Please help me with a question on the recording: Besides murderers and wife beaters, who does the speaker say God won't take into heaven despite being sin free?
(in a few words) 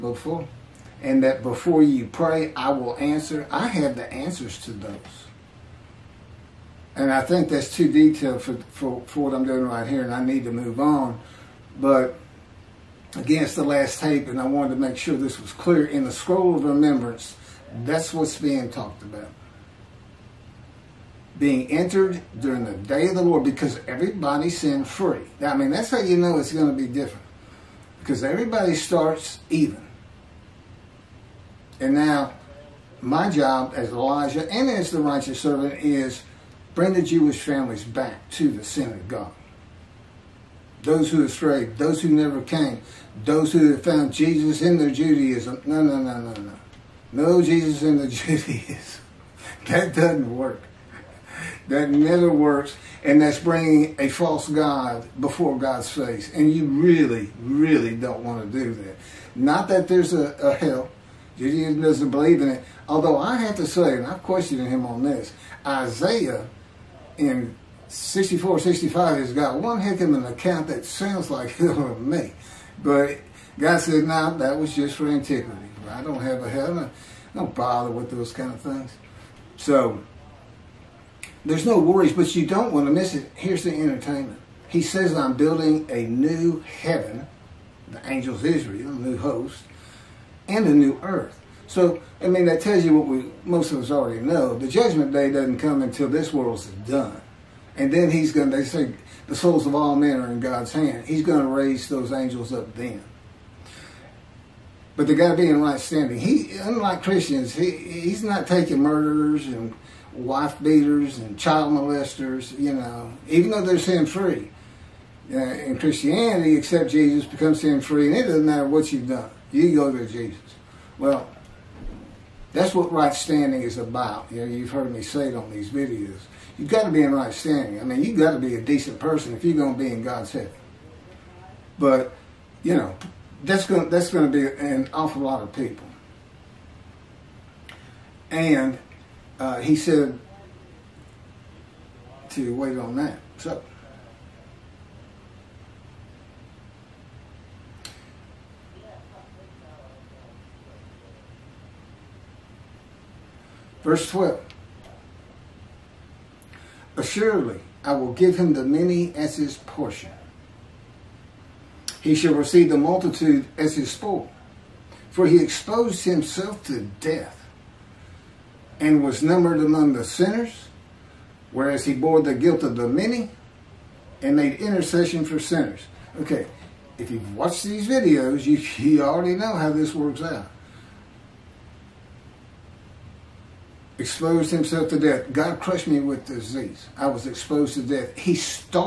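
Child molesters.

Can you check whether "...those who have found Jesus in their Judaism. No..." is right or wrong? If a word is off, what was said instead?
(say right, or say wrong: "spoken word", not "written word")
right.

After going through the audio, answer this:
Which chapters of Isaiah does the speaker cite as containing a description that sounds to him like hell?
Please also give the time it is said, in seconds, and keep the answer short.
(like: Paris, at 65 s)
64, 65, at 67 s.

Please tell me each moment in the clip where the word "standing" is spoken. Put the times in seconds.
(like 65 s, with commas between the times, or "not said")
105 s, 123 s, 127 s.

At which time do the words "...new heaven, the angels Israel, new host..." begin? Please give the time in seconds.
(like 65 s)
86 s.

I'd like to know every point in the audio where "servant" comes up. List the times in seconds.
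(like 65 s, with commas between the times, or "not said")
35 s.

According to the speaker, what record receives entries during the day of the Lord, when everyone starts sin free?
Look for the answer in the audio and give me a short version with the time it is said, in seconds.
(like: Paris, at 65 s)
Scroll of remembrance, at 16 s.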